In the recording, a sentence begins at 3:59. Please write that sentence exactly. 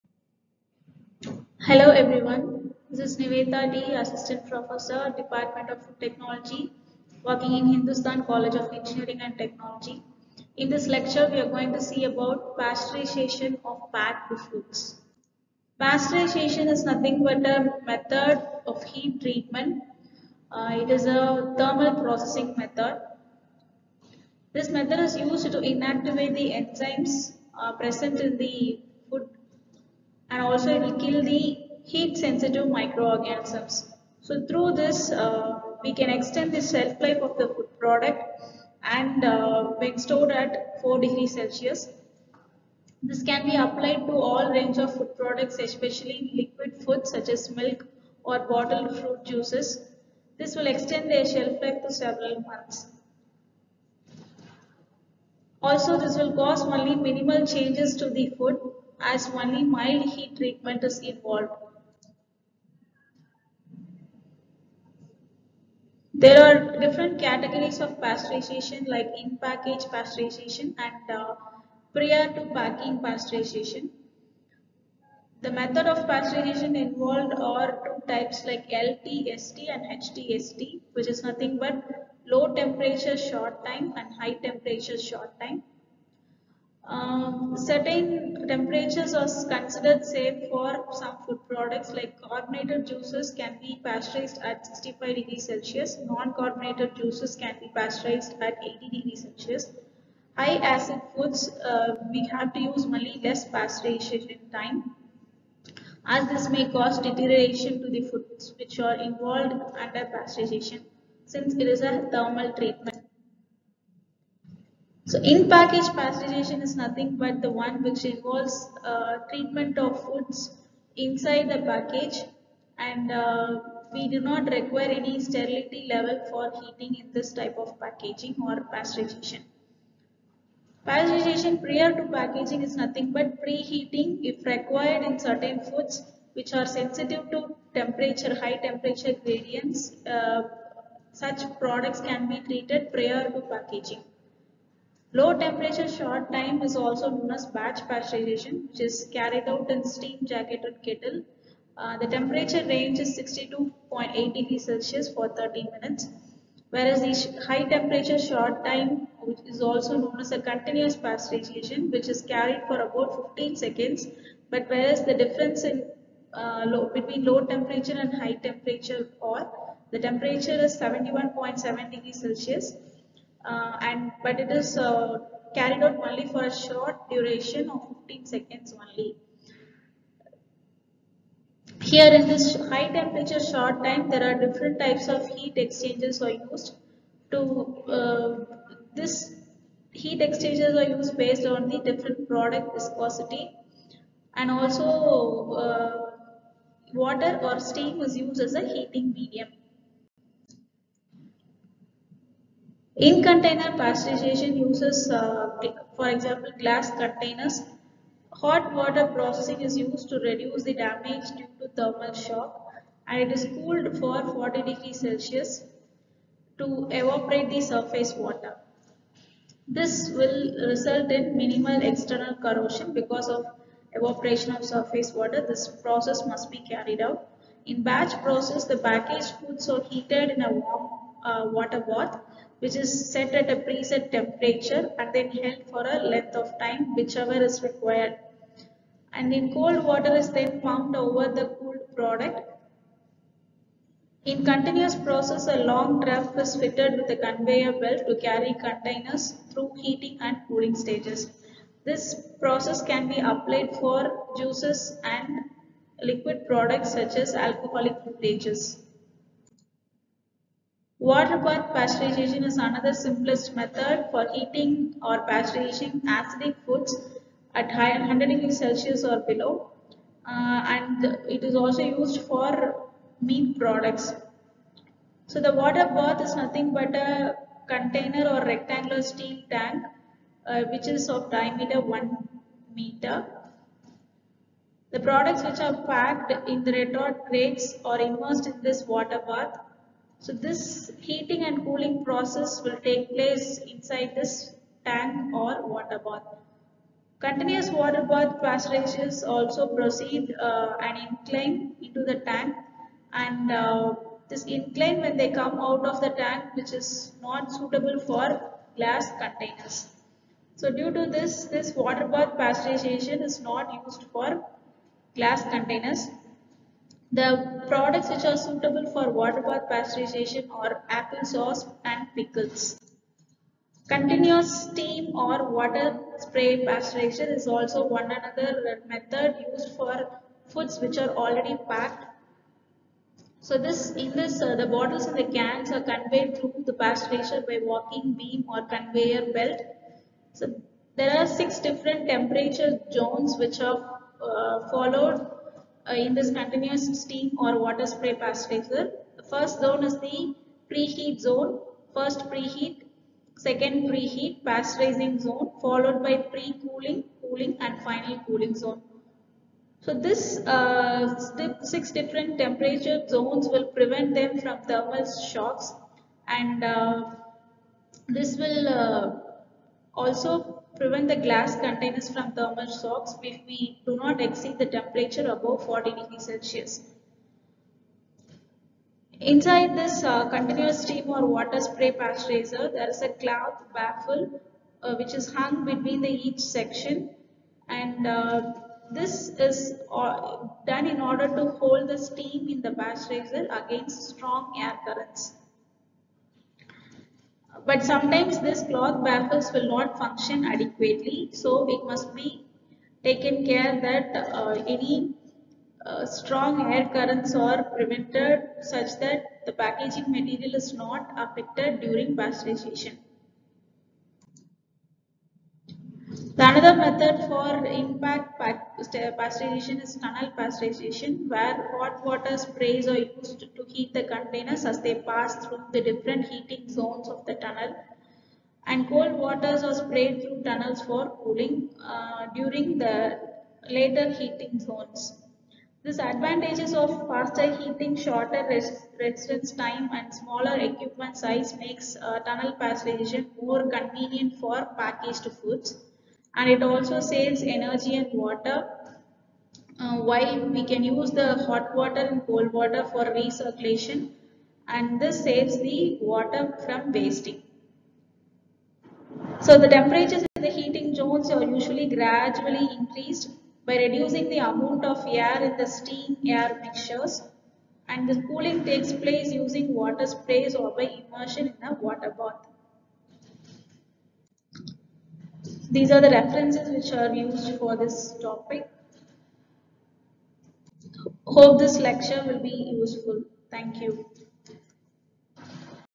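And in cold water is then pumped over the cooled product.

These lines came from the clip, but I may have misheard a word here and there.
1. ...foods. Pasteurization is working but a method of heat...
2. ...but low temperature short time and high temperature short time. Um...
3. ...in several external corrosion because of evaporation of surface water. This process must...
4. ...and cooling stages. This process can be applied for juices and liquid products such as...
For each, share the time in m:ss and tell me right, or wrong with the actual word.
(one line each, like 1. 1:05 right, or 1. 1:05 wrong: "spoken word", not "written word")
1. 0:14 wrong: "nothing", not "working"
2. 1:21 right
3. 3:41 wrong: "minimal", not "several"
4. 4:10 right.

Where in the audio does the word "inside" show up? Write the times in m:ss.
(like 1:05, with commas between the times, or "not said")
2:00, 4:53, 6:19.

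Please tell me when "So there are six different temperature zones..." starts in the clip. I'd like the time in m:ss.
5:40.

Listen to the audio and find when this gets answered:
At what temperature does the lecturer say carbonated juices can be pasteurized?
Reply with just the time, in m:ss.
1:34.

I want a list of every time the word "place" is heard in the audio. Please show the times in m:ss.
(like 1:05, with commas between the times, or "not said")
4:53, 7:48.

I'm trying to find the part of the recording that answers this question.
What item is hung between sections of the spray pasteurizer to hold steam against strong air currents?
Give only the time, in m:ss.
6:23.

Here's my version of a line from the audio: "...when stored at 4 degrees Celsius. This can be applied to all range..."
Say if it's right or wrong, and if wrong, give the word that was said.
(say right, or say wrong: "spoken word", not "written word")
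right.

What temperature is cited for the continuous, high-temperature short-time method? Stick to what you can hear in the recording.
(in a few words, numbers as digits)
71.7 degrees Celsius.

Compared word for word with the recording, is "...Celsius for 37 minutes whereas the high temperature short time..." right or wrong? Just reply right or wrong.
wrong.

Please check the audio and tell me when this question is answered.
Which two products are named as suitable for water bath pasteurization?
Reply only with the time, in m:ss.
5:20.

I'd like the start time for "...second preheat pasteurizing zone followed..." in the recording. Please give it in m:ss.
5:53.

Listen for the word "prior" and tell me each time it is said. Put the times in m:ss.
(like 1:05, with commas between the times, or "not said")
1:11, 2:11, 2:22.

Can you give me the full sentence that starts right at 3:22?
In container pasteurization uses, uh, for example, glass containers.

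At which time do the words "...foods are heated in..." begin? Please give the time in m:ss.
3:49.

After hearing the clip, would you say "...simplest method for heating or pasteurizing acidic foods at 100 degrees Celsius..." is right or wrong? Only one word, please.
right.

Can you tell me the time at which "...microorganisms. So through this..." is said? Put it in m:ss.
0:32.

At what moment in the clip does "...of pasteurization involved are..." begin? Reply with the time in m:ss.
1:15.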